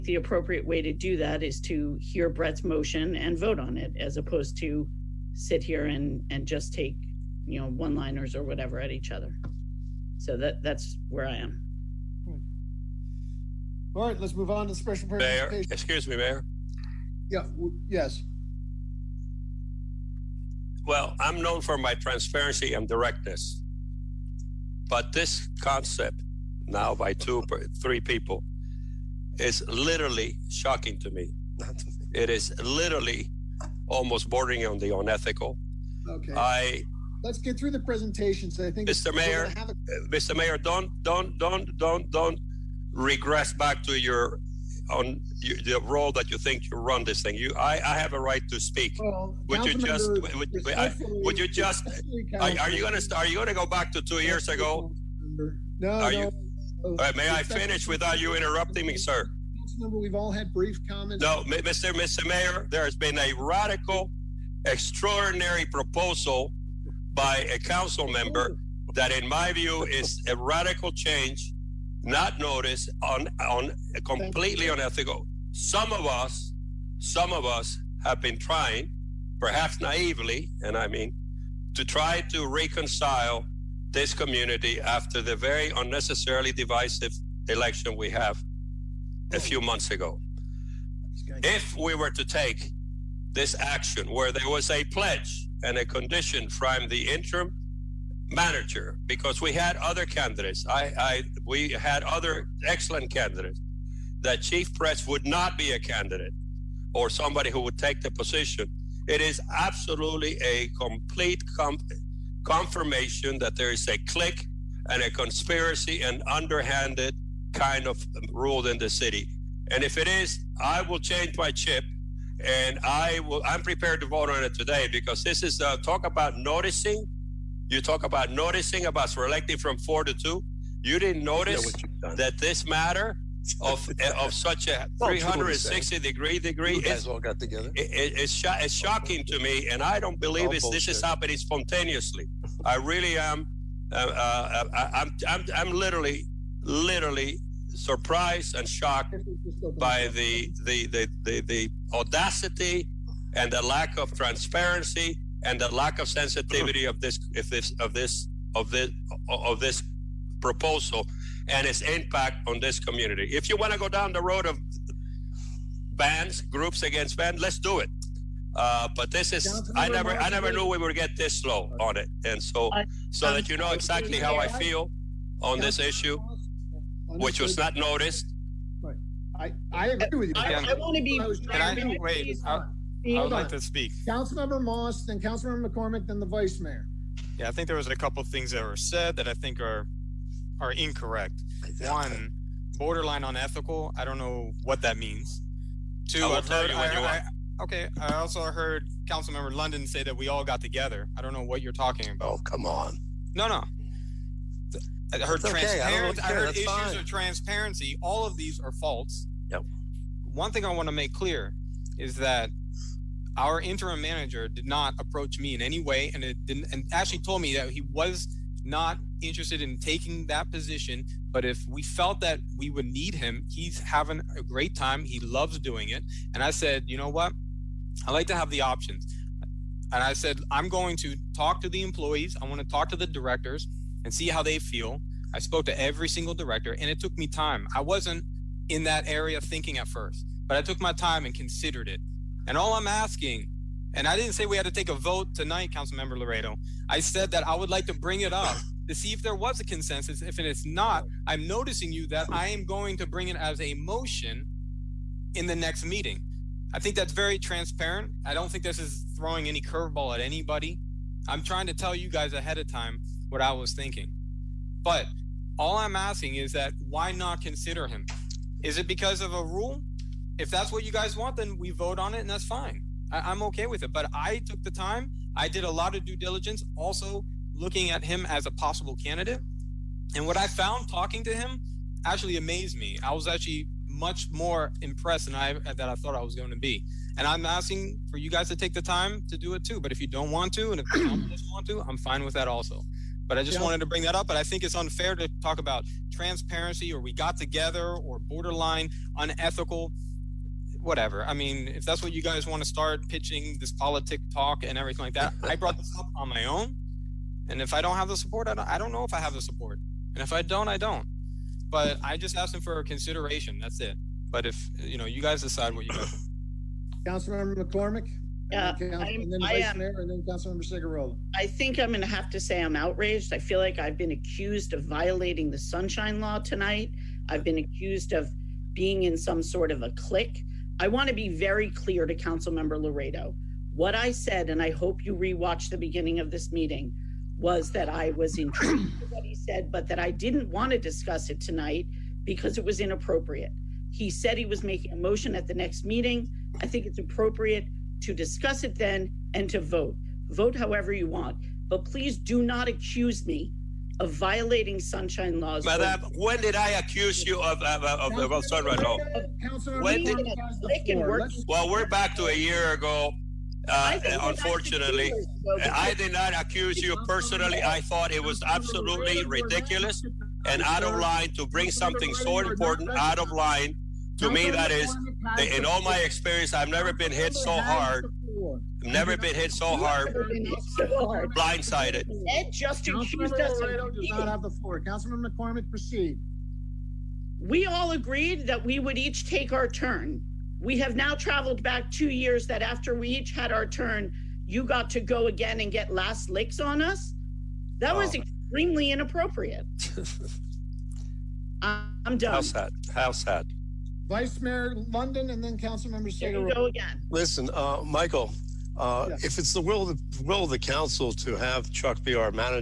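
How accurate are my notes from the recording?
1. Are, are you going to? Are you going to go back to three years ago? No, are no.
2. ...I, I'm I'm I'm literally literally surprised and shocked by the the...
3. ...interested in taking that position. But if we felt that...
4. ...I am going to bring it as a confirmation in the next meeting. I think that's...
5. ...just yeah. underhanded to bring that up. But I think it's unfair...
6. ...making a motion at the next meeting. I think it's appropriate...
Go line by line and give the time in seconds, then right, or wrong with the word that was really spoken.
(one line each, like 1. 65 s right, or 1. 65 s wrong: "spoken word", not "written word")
1. 52 s wrong: "two", not "three"
2. 144 s right
3. 219 s right
4. 252 s wrong: "motion", not "confirmation"
5. 293 s wrong: "wanted", not "underhanded"
6. 344 s right.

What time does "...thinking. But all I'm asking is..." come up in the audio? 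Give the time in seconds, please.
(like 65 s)
263 s.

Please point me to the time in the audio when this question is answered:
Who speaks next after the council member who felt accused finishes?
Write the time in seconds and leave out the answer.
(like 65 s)
404 s.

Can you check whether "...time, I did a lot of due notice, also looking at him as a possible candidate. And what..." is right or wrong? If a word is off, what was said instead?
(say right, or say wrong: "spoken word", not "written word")
wrong: "diligence", not "notice".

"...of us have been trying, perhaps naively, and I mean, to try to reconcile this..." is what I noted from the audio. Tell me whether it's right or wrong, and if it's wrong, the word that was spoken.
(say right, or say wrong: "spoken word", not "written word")
right.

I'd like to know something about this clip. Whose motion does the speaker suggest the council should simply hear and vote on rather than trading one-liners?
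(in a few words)
Brett.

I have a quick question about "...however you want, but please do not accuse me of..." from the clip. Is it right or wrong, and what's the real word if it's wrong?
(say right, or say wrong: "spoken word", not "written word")
right.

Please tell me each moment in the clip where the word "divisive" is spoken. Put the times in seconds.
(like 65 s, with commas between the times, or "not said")
86 s.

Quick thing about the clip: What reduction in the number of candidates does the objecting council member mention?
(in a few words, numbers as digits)
four to two.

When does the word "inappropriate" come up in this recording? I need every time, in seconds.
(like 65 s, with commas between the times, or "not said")
342 s, 398 s.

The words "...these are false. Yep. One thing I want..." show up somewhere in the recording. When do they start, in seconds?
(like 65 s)
208 s.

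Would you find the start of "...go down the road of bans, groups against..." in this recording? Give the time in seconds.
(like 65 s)
163 s.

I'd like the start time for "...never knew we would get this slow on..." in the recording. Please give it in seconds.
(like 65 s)
170 s.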